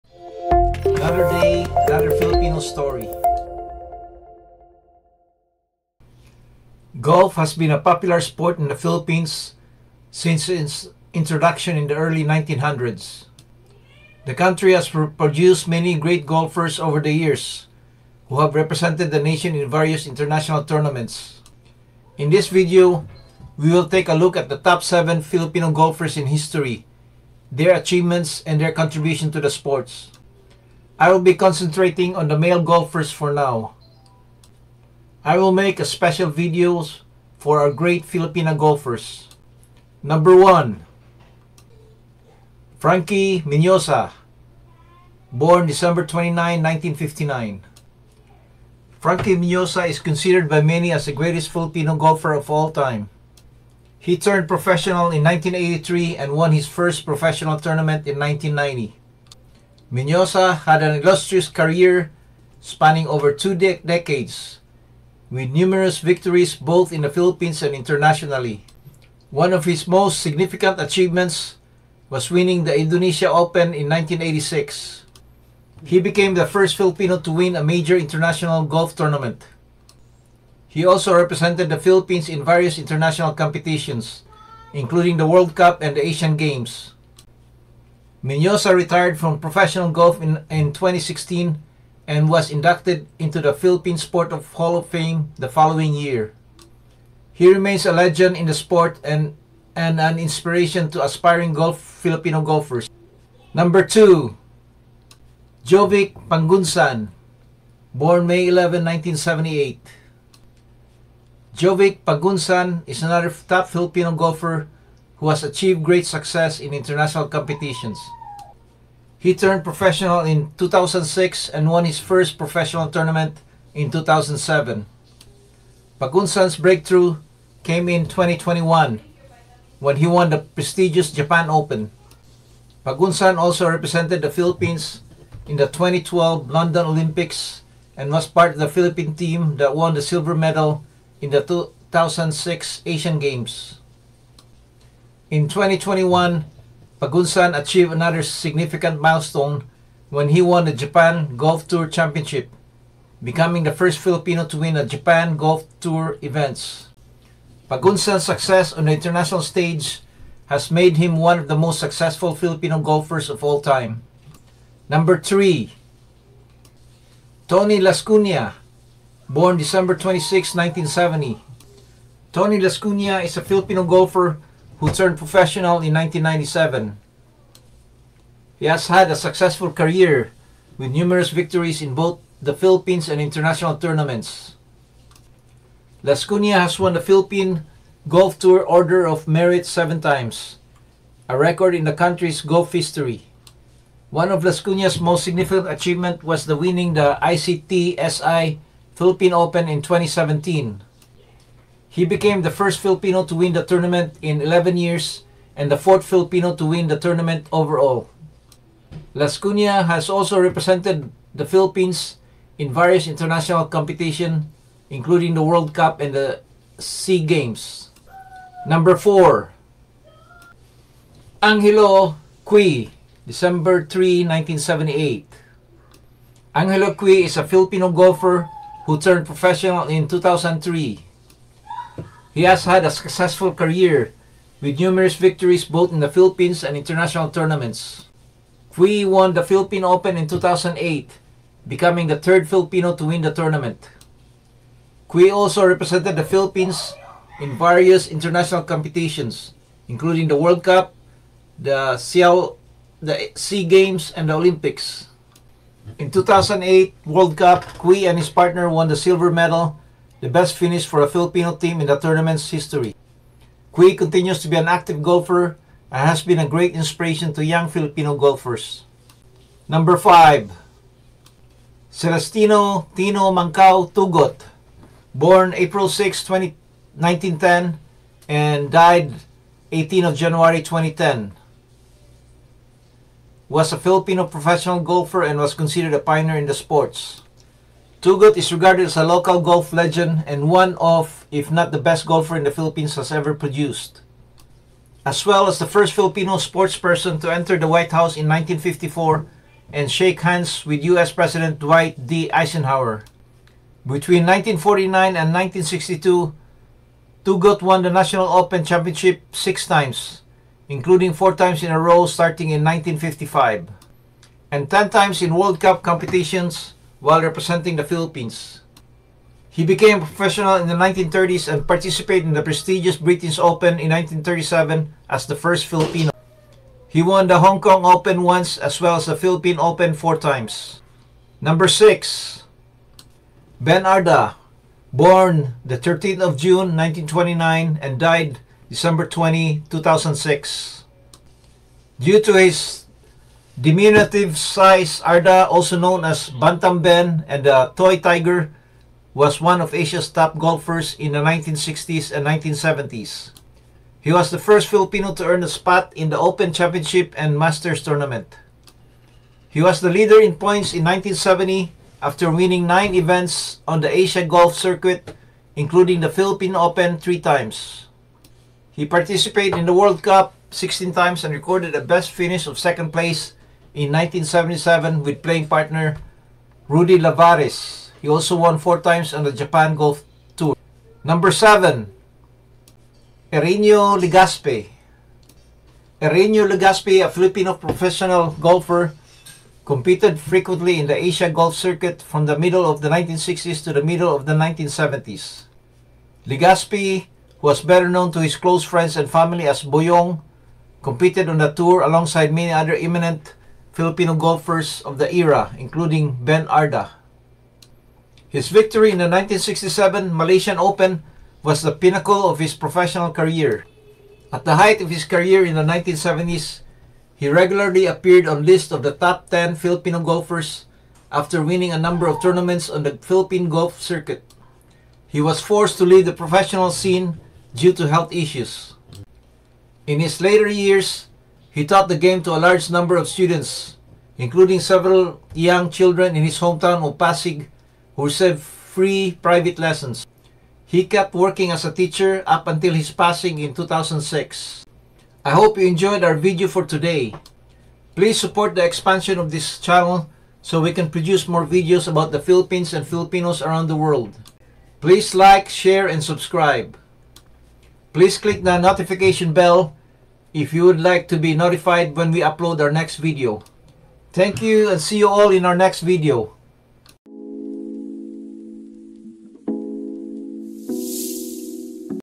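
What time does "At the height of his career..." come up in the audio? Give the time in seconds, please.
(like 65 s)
414 s.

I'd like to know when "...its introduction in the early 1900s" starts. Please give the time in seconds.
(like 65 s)
10 s.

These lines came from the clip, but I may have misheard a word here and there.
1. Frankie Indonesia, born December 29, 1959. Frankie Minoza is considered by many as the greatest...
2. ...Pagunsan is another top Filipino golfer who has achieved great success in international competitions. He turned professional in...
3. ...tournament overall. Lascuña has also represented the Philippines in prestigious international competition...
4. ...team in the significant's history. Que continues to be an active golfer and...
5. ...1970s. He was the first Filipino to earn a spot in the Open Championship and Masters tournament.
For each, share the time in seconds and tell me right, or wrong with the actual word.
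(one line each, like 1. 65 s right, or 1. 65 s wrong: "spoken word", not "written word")
1. 42 s wrong: "Minoza", not "Indonesia"
2. 112 s right
3. 206 s wrong: "various", not "prestigious"
4. 261 s wrong: "tournament", not "significant"
5. 352 s right.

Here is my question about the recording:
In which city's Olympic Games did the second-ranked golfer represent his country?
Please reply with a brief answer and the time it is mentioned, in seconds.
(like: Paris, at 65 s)
London, at 136 s.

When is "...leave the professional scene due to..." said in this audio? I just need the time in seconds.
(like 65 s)
425 s.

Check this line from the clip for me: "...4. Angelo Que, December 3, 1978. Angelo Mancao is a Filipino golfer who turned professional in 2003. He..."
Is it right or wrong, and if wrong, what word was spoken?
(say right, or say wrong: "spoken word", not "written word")
wrong: "Que", not "Mancao".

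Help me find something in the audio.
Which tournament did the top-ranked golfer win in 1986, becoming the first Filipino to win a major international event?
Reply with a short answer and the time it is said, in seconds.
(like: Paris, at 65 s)
Indonesia Open, at 72 s.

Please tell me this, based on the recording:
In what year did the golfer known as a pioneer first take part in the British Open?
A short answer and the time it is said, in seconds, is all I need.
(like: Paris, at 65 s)
1937, at 323 s.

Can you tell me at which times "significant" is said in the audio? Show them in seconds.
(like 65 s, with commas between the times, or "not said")
70 s, 148 s, 195 s.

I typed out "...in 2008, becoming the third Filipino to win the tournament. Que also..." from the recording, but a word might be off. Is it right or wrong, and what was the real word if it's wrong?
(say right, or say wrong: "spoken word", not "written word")
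right.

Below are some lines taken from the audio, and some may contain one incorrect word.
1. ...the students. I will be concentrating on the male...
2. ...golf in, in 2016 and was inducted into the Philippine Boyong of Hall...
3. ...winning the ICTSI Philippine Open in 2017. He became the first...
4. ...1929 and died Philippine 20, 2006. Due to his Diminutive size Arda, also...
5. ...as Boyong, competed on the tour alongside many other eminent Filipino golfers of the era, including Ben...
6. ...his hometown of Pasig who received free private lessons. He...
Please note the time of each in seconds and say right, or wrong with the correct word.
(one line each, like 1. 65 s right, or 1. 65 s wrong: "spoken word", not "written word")
1. 29 s wrong: "sports", not "students"
2. 89 s wrong: "Sport", not "Boyong"
3. 196 s right
4. 336 s wrong: "December", not "Philippine"
5. 399 s right
6. 436 s right.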